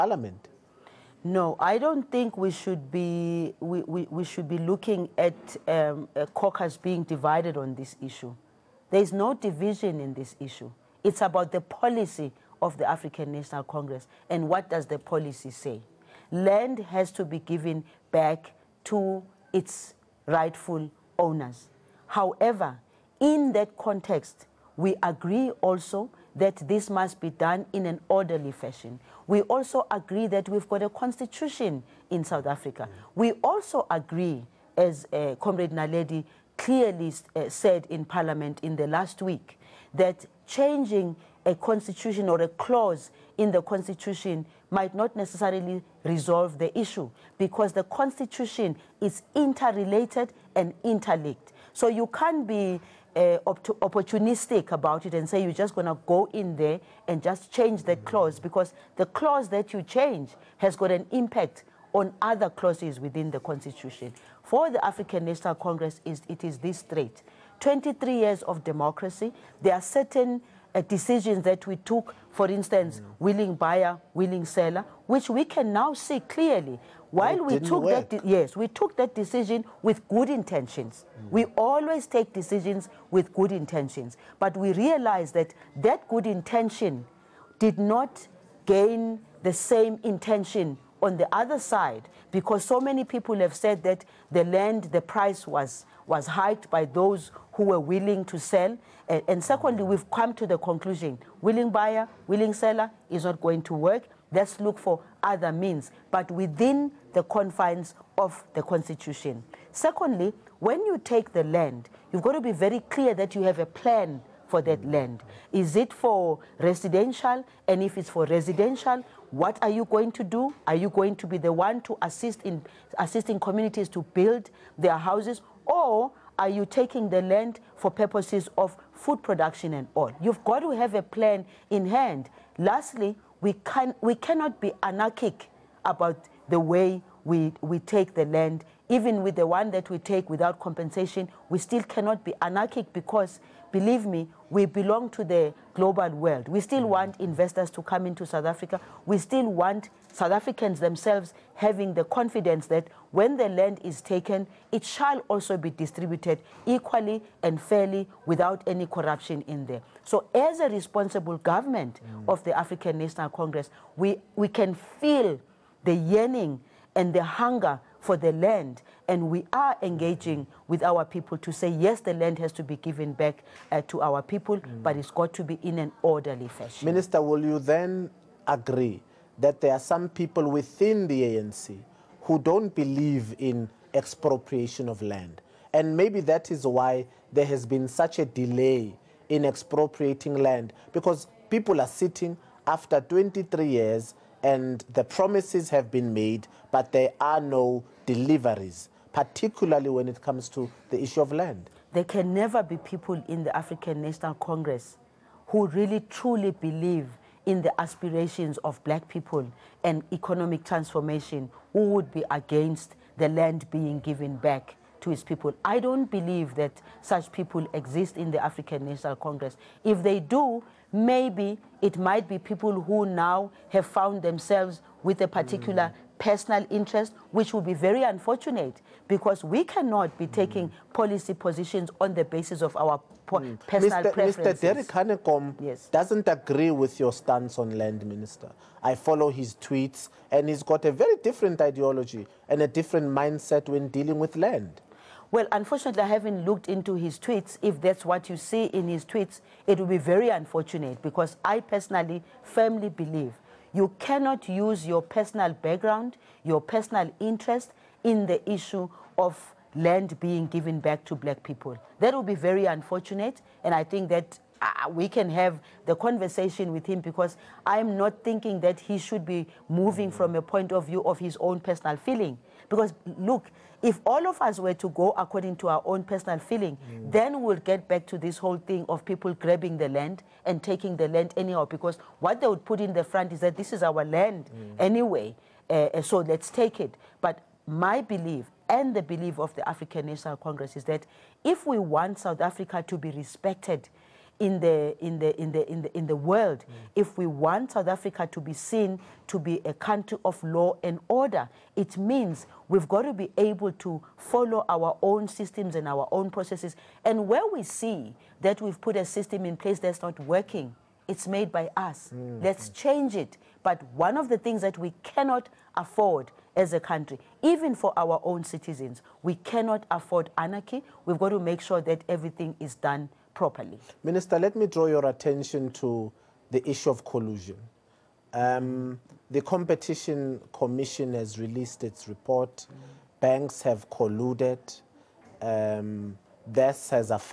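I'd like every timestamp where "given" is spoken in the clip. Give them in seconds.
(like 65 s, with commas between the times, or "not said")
17 s, 172 s, 213 s, 260 s.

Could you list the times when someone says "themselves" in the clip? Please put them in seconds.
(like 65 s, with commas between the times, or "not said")
150 s, 224 s.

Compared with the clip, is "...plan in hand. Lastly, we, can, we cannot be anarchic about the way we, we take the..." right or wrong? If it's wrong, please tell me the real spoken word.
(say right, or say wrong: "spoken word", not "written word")
right.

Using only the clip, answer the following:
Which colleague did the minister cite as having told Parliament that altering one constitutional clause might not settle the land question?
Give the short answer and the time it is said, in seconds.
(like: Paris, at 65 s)
Naledi, at 35 s.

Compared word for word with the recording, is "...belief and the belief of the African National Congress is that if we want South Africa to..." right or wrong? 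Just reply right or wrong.
right.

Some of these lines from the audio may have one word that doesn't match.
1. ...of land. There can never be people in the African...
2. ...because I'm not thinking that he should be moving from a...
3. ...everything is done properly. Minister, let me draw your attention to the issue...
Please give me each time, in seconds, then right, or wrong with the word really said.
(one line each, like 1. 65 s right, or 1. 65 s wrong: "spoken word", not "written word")
1. 201 s right
2. 267 s right
3. 322 s right.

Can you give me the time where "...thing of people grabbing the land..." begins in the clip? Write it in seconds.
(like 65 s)
278 s.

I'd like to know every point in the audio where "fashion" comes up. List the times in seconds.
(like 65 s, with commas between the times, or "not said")
28 s, 176 s.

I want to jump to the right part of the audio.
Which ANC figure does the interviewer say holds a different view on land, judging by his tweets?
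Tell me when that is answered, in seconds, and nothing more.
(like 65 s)
234 s.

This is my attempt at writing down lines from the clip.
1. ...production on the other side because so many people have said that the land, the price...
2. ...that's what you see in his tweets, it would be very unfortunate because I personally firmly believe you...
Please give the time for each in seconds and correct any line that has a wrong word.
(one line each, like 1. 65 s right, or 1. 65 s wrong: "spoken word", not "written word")
1. 90 s wrong: "intention", not "production"
2. 247 s right.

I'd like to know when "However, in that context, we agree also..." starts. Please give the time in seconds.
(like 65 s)
22 s.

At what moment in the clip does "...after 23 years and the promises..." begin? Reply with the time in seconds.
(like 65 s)
192 s.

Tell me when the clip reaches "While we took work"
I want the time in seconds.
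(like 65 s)
77 s.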